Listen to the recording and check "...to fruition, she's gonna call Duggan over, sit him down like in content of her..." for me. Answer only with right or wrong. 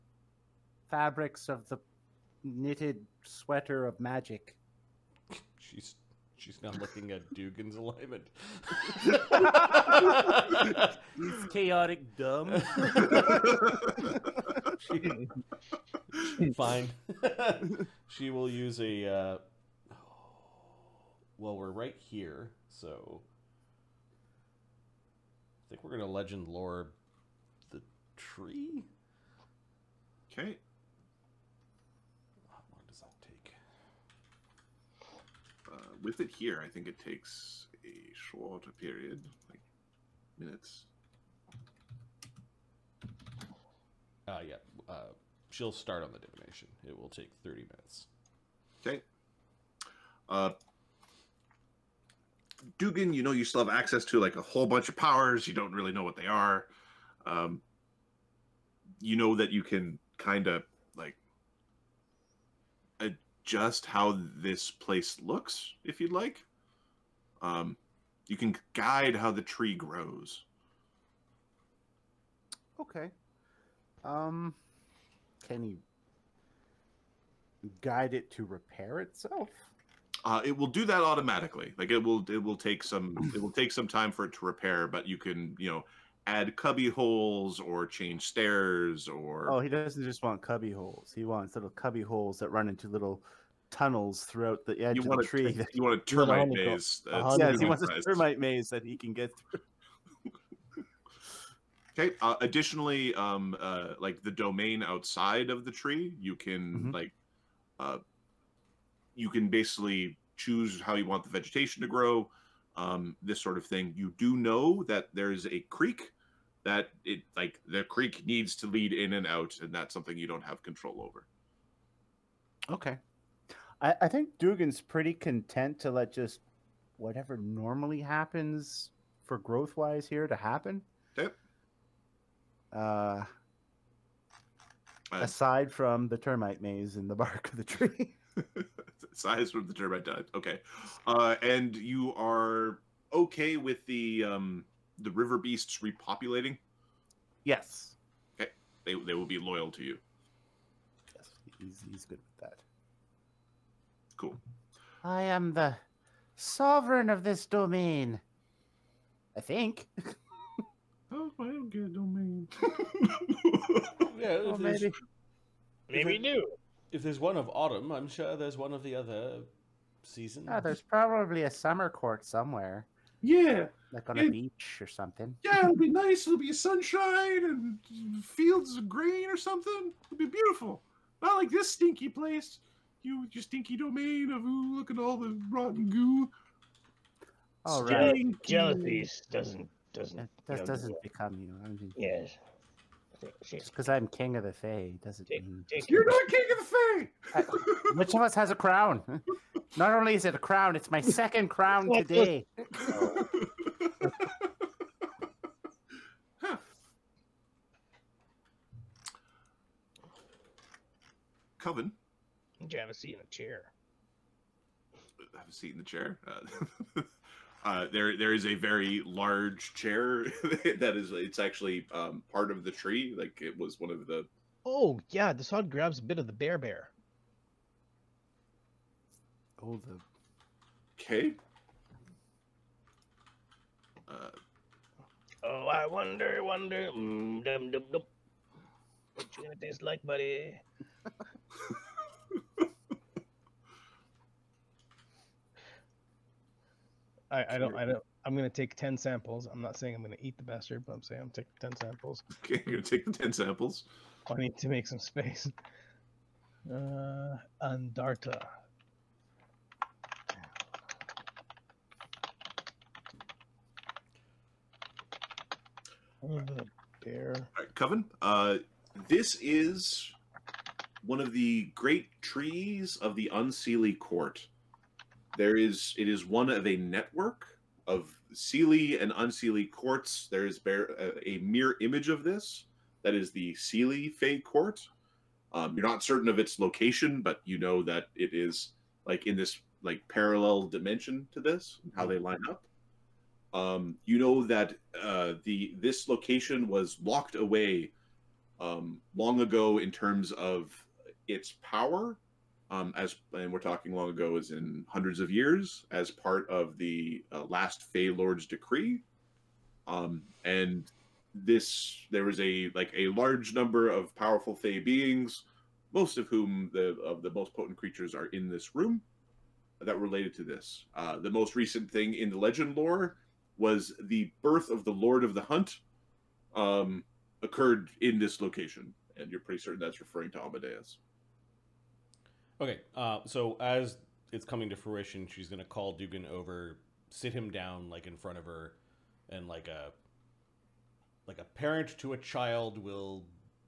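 wrong.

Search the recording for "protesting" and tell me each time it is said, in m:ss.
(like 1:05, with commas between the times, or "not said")
not said.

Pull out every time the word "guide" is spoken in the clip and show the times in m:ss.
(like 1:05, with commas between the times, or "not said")
1:08, 1:17.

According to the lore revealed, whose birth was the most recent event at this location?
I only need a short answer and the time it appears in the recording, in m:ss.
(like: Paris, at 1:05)
Lord of the Hunt, at 5:24.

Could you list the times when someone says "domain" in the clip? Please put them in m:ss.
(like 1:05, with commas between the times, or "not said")
1:44, 2:37, 2:41, 3:03.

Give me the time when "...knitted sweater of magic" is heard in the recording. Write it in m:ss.
0:02.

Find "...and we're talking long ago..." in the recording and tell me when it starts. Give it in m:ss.
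5:03.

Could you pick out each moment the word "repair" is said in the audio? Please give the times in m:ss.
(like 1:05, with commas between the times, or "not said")
1:18, 1:24.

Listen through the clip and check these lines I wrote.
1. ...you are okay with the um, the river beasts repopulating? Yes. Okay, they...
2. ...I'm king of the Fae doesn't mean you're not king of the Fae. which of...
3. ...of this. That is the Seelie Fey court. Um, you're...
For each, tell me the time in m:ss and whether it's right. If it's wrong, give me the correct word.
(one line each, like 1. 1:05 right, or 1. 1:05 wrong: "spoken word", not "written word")
1. 2:21 right
2. 3:13 right
3. 4:42 right.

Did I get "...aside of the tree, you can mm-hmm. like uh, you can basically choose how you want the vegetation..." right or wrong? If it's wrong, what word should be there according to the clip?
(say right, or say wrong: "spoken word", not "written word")
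wrong: "outside", not "aside".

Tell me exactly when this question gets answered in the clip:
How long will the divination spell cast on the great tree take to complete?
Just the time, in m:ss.
0:47.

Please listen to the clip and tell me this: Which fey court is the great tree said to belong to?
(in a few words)
Unseelie Court.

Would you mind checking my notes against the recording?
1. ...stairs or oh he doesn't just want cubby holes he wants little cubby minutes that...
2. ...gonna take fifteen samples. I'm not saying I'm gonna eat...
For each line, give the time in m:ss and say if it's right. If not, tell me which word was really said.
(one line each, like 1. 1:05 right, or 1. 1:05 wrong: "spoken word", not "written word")
1. 1:28 wrong: "holes", not "minutes"
2. 4:08 wrong: "ten", not "fifteen".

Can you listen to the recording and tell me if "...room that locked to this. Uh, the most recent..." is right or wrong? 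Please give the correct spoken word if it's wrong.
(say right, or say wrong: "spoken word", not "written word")
wrong: "related", not "locked".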